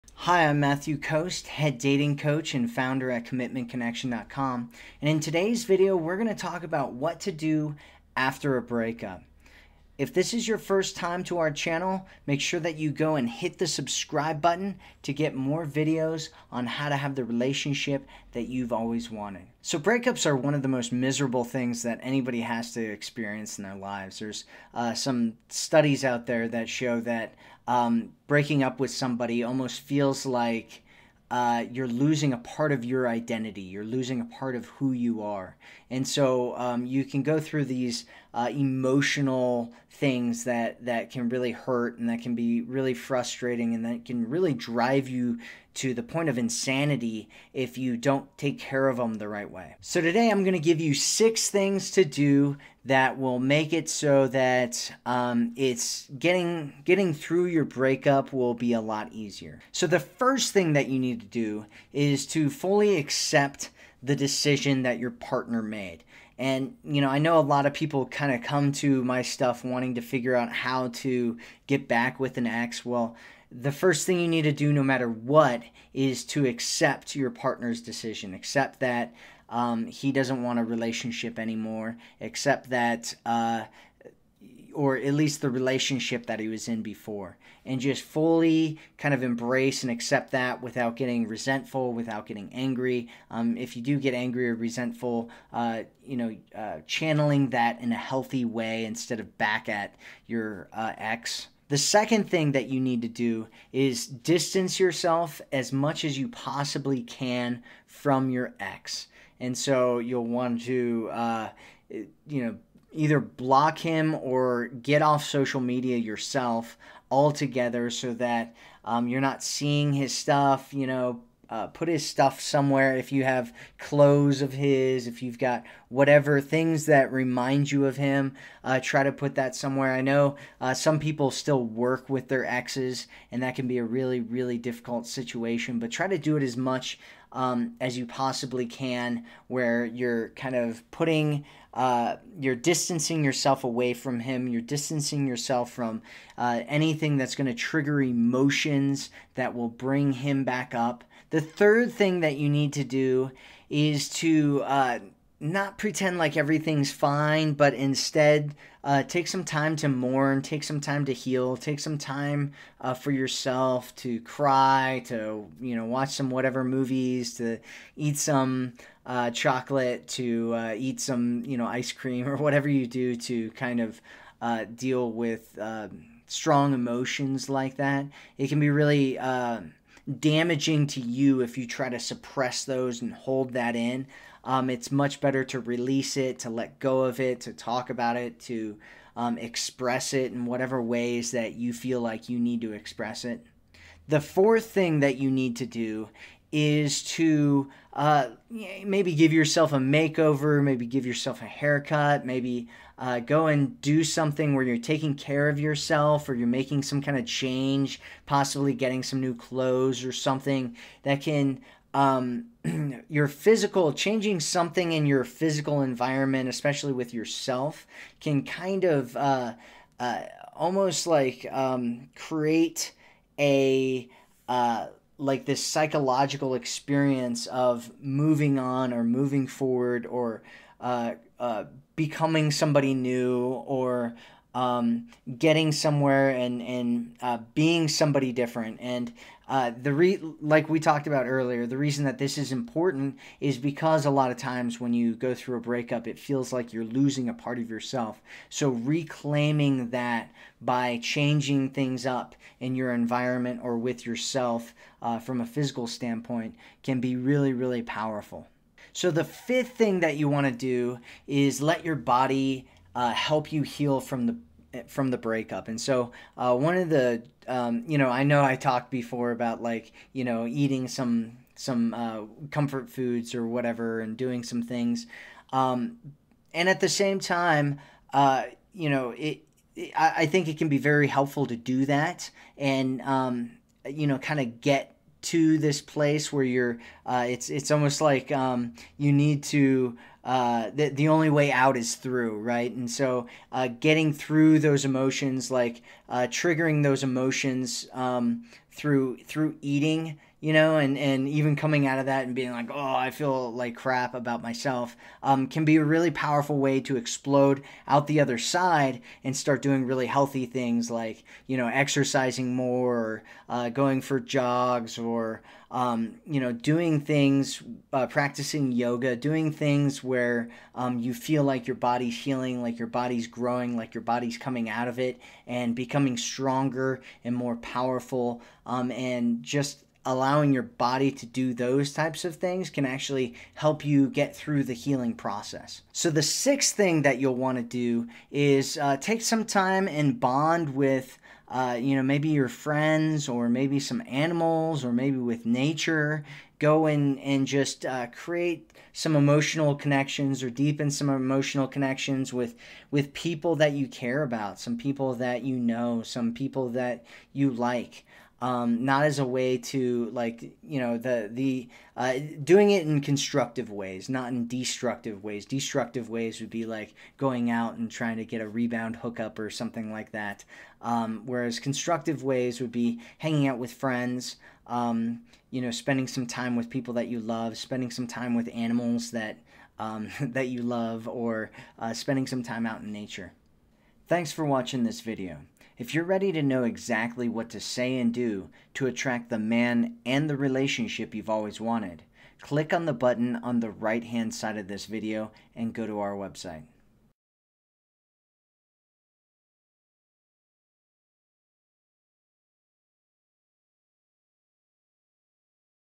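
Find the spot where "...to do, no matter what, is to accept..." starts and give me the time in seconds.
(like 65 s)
74 s.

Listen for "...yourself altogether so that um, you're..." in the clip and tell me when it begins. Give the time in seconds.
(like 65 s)
115 s.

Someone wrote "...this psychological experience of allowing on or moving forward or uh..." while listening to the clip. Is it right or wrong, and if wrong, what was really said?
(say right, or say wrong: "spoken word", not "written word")
wrong: "moving", not "allowing".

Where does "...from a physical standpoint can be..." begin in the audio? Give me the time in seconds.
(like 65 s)
255 s.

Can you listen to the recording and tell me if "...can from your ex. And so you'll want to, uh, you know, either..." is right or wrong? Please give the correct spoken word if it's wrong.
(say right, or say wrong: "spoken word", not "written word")
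right.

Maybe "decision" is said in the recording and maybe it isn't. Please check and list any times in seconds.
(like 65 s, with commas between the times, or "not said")
64 s, 77 s.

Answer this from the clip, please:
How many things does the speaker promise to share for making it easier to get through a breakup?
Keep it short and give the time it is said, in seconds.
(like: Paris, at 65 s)
6, at 50 s.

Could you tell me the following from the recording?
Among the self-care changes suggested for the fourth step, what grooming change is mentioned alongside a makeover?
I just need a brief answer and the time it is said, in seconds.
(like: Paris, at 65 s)
a haircut, at 201 s.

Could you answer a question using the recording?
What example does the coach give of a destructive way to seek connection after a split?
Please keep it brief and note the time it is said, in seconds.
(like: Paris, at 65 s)
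a rebound hookup, at 368 s.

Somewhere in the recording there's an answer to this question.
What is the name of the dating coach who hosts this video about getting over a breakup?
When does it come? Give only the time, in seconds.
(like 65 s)
0 s.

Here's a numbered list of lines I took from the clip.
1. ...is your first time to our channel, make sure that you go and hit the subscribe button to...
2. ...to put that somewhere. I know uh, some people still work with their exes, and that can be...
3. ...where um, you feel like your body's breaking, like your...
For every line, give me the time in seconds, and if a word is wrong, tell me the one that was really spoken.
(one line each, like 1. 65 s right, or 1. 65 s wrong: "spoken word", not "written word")
1. 10 s right
2. 129 s right
3. 320 s wrong: "healing", not "breaking".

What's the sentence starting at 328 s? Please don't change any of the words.
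Um, and just allowing your body to do those types of things can actually help you get through the healing process.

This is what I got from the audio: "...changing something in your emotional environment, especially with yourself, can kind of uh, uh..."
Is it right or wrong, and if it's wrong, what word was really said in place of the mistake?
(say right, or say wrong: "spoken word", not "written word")
wrong: "physical", not "emotional".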